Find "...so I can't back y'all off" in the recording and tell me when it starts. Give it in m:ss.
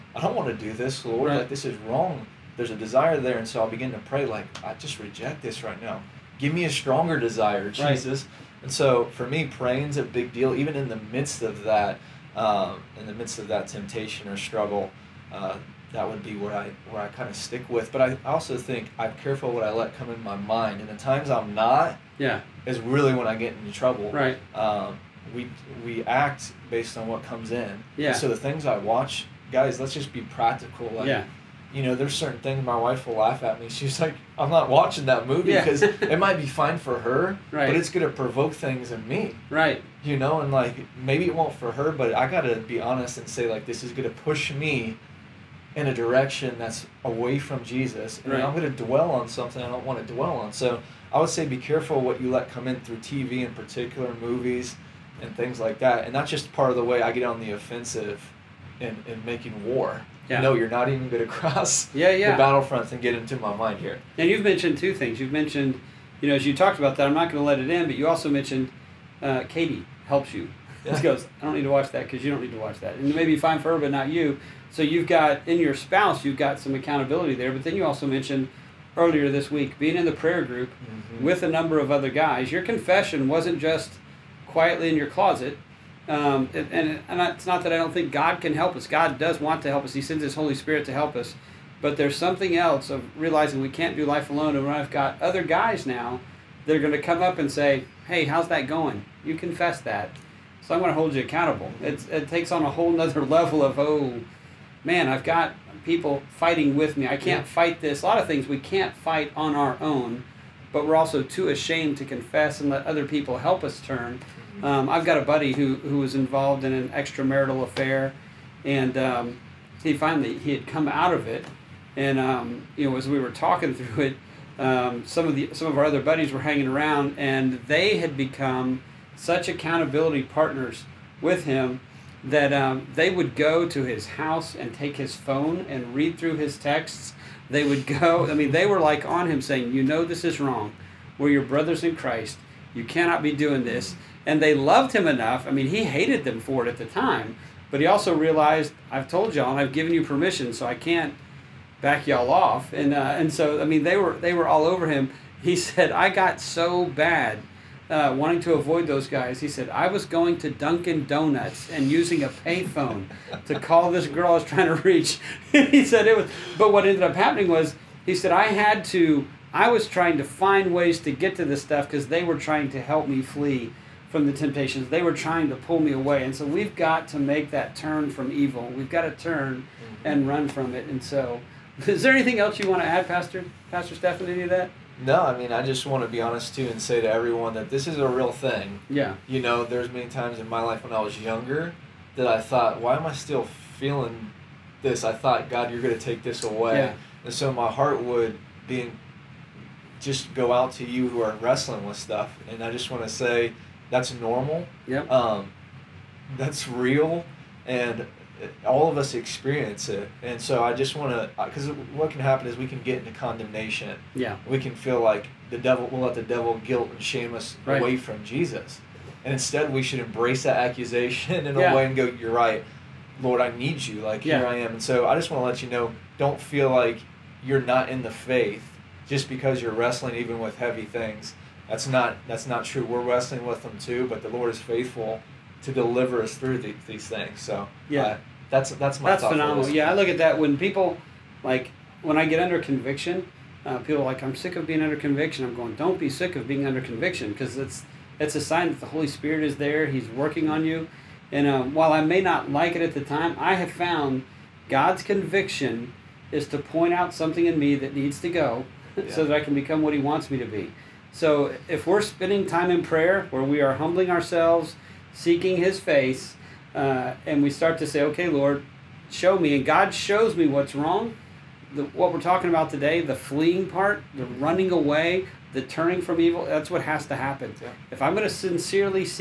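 2:30.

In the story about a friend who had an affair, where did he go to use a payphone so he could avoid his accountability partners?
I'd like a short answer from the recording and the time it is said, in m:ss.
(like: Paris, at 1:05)
Dunkin' Donuts, at 2:40.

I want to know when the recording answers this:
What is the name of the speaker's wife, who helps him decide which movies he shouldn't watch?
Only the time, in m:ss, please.
1:09.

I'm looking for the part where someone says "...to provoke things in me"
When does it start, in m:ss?
0:38.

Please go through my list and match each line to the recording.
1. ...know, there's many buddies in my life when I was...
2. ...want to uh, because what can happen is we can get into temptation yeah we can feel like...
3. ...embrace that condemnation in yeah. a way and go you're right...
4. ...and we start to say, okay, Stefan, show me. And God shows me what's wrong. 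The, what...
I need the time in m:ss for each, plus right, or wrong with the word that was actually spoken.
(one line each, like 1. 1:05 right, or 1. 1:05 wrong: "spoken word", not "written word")
1. 3:09 wrong: "times", not "buddies"
2. 3:30 wrong: "condemnation", not "temptation"
3. 3:39 wrong: "accusation", not "condemnation"
4. 4:27 wrong: "Lord", not "Stefan".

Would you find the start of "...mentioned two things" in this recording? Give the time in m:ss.
1:04.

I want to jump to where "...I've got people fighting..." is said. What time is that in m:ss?
1:45.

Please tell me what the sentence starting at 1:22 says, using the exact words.
Your confession wasn't just quietly in your closet, um, and, and, it's not that I don't think God can help us.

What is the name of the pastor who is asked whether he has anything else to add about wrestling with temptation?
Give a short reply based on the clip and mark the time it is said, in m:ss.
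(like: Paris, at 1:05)
Pastor Stefan, at 3:03.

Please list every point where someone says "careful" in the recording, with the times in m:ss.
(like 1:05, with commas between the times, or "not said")
0:19, 0:51.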